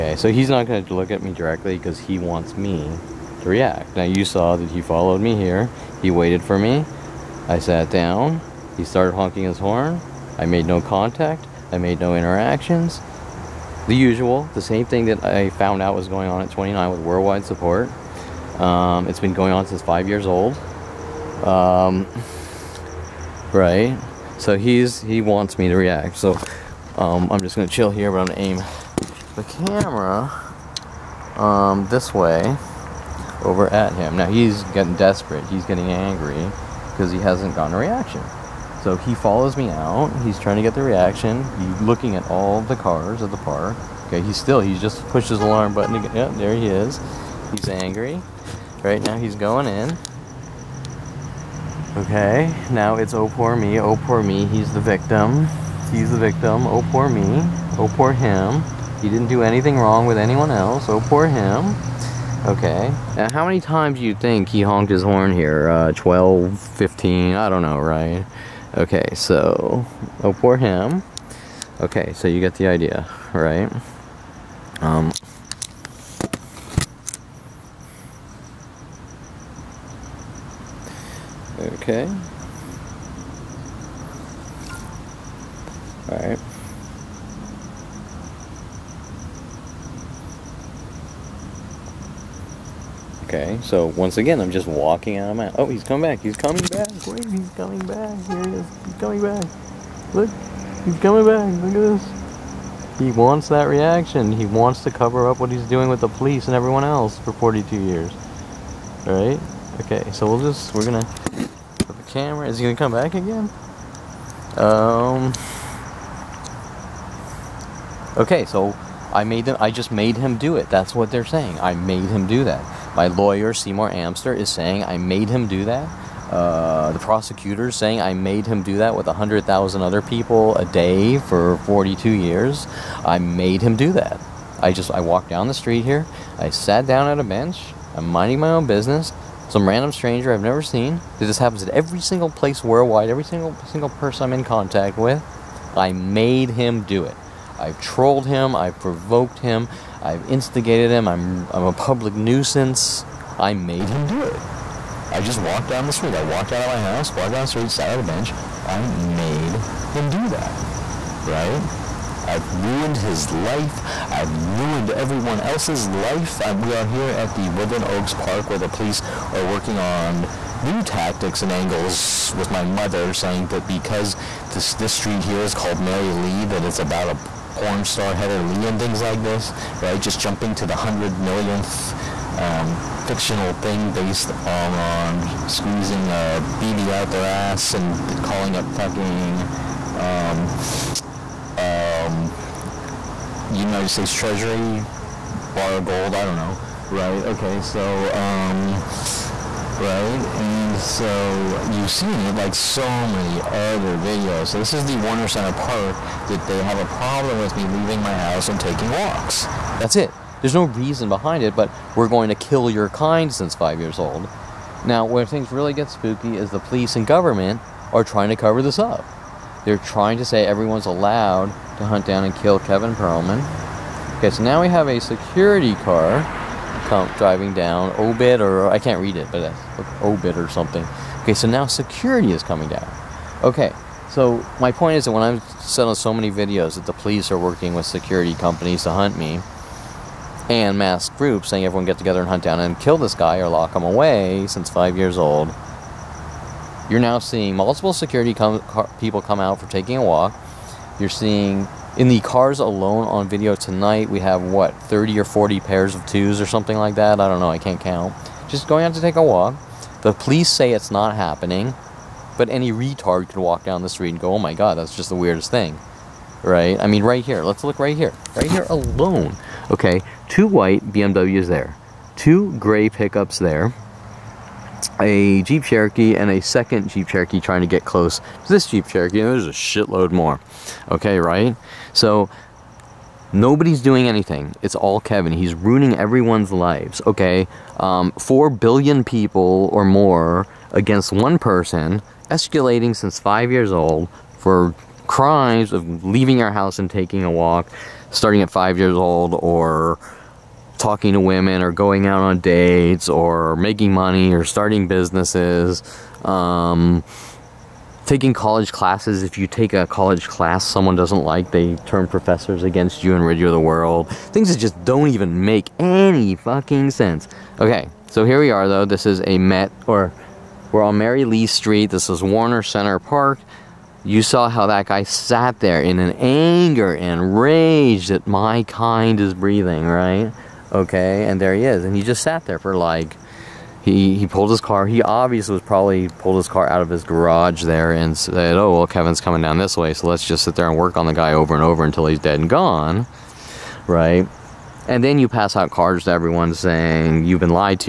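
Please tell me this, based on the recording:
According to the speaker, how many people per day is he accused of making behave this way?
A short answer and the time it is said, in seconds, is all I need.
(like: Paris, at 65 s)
100,000, at 129 s.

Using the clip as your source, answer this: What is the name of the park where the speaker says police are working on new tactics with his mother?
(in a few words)
Woodland Oaks Park.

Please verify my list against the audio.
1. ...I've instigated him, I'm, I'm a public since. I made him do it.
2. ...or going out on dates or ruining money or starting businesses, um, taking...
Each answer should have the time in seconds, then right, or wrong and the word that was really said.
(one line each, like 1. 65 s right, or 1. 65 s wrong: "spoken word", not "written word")
1. 150 s wrong: "nuisance", not "since"
2. 301 s wrong: "making", not "ruining".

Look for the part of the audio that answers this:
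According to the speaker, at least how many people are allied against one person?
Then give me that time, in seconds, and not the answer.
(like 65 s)
288 s.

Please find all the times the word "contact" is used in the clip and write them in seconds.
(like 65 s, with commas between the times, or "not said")
10 s, 144 s.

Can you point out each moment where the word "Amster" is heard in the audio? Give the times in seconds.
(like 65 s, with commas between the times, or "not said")
123 s.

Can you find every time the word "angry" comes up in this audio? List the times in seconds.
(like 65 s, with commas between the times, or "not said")
35 s, 47 s.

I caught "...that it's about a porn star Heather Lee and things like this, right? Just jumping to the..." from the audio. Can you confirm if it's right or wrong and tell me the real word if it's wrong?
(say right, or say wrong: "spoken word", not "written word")
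right.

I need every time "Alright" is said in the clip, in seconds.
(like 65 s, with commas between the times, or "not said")
86 s, 109 s.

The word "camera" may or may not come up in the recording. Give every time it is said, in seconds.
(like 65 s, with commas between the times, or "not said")
29 s, 112 s.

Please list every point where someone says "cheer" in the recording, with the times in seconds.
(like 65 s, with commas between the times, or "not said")
not said.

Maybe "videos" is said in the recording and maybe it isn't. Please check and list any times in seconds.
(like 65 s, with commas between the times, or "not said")
203 s, 236 s, 253 s.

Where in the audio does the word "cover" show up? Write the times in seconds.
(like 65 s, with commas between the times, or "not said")
104 s, 218 s.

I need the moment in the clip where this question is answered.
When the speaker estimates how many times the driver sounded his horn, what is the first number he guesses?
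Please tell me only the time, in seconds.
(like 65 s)
65 s.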